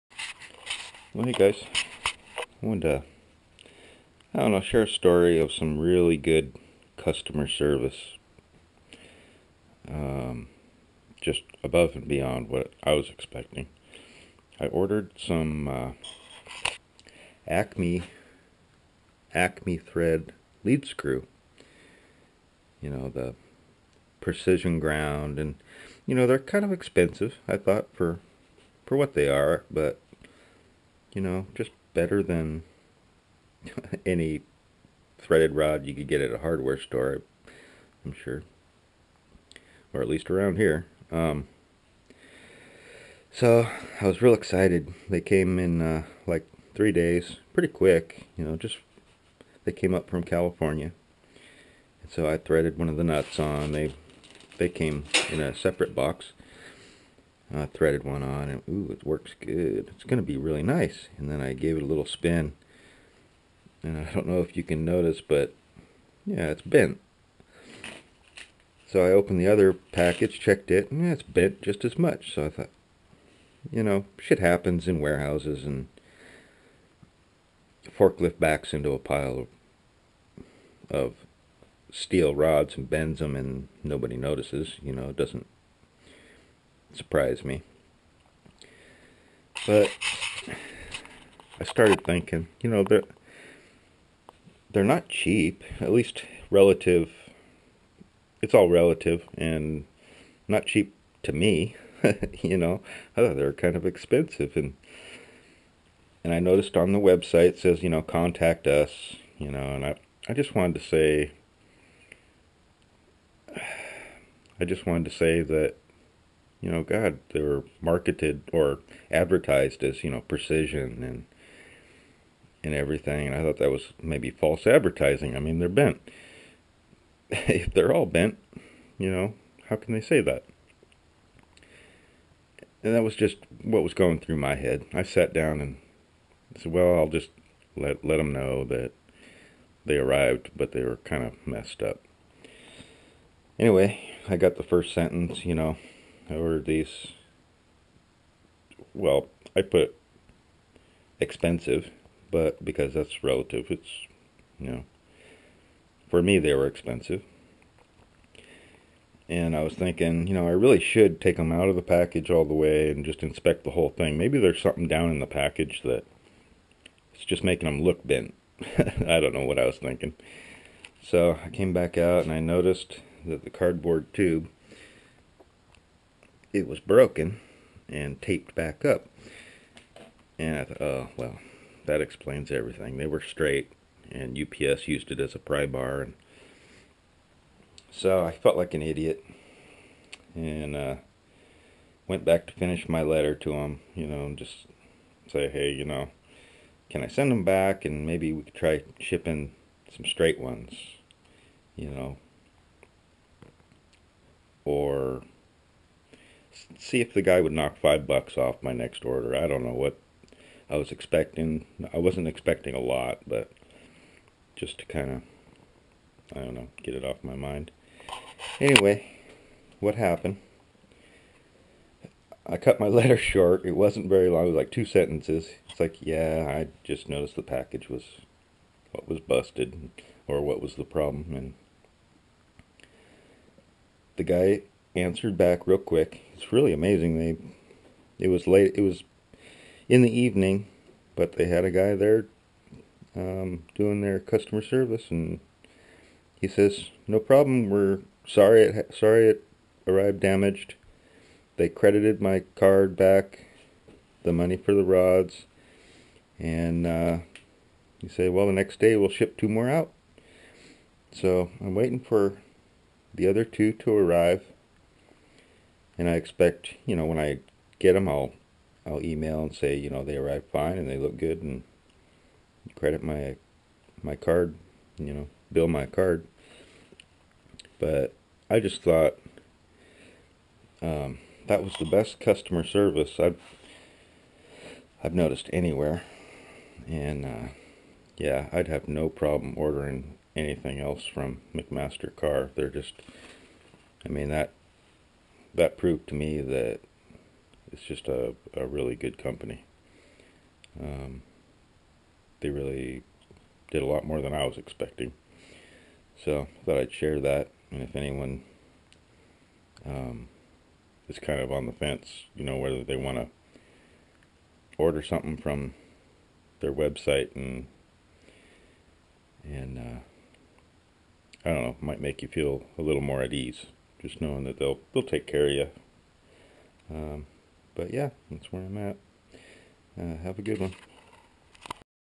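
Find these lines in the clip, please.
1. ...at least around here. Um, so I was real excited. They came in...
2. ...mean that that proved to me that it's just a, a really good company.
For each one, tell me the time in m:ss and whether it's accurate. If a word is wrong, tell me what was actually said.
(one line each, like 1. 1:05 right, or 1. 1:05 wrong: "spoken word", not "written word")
1. 0:40 right
2. 4:54 right.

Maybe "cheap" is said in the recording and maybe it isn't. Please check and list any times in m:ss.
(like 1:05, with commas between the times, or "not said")
1:35, 1:40.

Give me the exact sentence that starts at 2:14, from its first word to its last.
I sat down and said, well, I'll just let, let them know that they arrived, but they were kind of messed up.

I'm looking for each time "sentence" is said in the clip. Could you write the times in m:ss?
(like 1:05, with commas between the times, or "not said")
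2:24, 3:44.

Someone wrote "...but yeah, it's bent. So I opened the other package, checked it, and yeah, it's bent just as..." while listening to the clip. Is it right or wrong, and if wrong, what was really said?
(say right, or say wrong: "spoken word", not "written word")
right.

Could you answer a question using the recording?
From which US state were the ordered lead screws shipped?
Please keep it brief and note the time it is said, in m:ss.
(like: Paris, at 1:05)
California, at 0:50.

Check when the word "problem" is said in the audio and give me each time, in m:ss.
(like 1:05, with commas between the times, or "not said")
3:50, 4:07, 4:49.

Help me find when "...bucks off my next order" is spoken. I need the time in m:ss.
3:28.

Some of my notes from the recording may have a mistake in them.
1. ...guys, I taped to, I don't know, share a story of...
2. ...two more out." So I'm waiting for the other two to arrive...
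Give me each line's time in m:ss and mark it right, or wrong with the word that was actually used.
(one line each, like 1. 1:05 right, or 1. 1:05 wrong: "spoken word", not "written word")
1. 0:01 wrong: "wanted", not "taped"
2. 4:19 right.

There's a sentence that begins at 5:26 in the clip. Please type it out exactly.
Um, but yeah, that's where I'm at.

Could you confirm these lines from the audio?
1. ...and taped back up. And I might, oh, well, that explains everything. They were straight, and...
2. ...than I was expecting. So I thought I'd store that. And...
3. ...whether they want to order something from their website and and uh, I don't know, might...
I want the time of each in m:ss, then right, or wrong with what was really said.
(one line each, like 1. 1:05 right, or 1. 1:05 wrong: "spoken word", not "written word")
1. 2:57 wrong: "thought", not "might"
2. 5:04 wrong: "share", not "store"
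3. 5:12 right.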